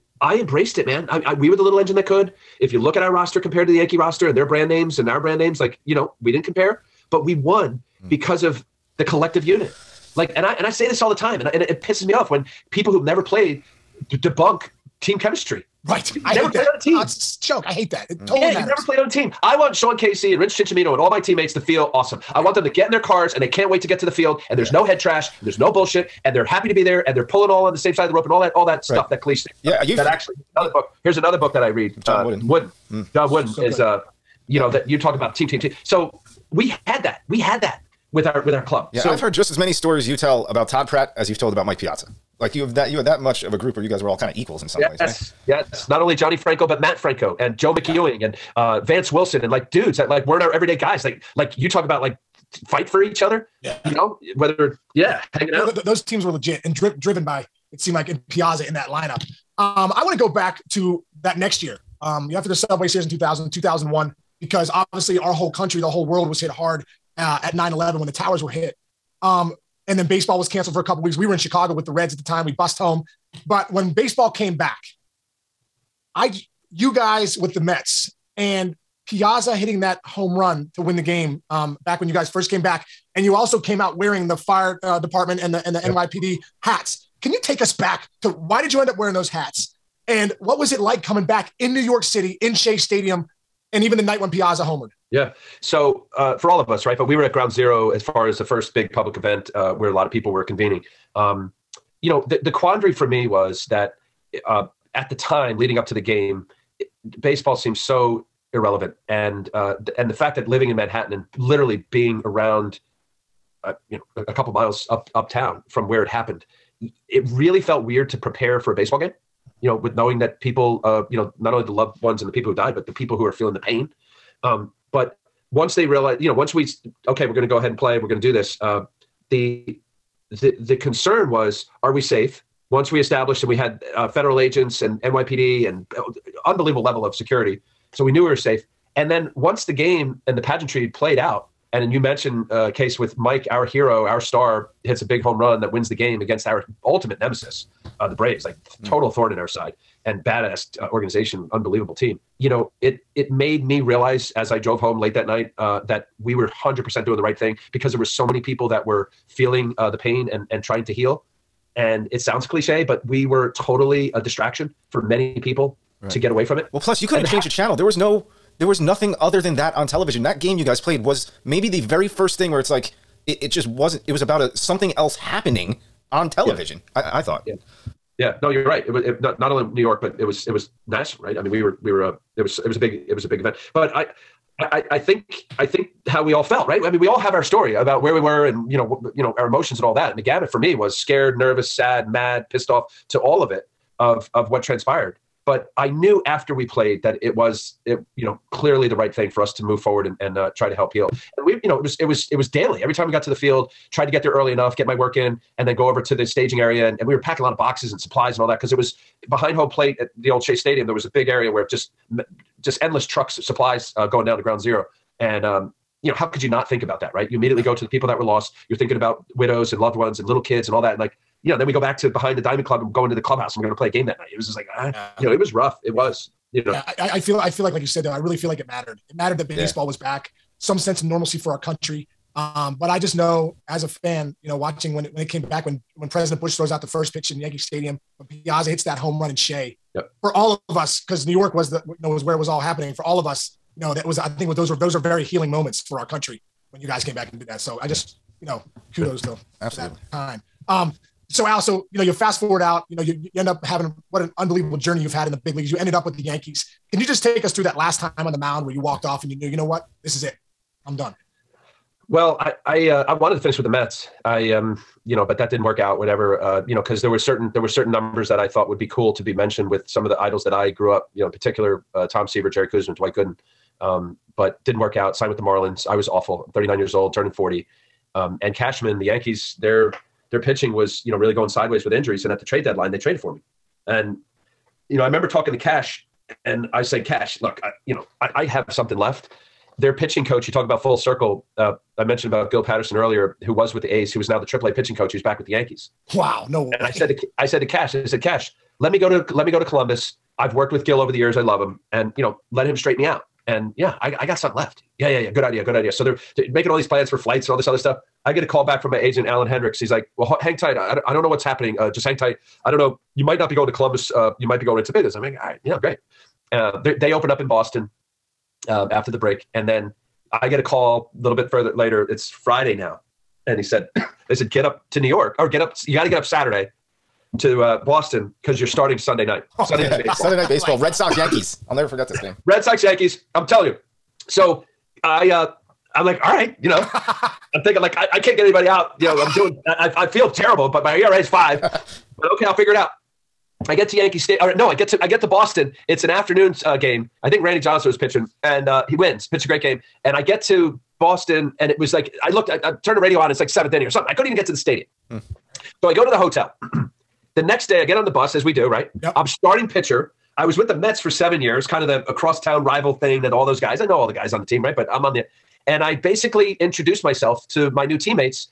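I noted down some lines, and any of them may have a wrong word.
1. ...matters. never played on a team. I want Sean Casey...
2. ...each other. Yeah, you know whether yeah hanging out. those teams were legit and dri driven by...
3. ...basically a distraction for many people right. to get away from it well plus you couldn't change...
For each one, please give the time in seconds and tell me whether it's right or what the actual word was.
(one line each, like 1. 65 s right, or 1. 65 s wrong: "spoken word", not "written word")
1. 18 s right
2. 53 s right
3. 163 s wrong: "totally", not "basically".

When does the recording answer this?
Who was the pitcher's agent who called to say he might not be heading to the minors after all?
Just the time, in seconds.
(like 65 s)
309 s.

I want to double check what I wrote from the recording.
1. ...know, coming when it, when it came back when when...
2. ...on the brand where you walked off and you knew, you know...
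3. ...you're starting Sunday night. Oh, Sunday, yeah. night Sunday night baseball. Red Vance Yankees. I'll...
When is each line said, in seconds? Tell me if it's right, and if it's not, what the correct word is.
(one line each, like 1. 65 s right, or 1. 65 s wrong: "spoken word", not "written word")
1. 234 s wrong: "watching", not "coming"
2. 258 s wrong: "mound", not "brand"
3. 328 s wrong: "Sox", not "Vance".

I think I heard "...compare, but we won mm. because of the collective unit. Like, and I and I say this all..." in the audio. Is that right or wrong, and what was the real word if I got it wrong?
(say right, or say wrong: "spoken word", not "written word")
right.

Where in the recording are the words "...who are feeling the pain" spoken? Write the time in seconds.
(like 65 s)
123 s.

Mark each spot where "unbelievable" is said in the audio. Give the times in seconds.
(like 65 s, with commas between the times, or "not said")
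136 s, 151 s, 254 s.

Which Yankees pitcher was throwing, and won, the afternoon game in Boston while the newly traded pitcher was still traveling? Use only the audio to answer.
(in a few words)
Randy Johnson.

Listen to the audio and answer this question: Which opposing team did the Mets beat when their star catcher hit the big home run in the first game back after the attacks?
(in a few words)
the Braves.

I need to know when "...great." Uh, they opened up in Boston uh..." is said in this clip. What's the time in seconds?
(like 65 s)
315 s.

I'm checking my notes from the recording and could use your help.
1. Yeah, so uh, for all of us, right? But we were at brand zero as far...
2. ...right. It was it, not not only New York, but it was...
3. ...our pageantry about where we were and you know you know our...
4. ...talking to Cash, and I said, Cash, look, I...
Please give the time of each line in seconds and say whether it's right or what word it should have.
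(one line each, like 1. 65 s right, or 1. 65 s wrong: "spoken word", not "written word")
1. 95 s wrong: "ground", not "brand"
2. 178 s right
3. 187 s wrong: "story", not "pageantry"
4. 285 s right.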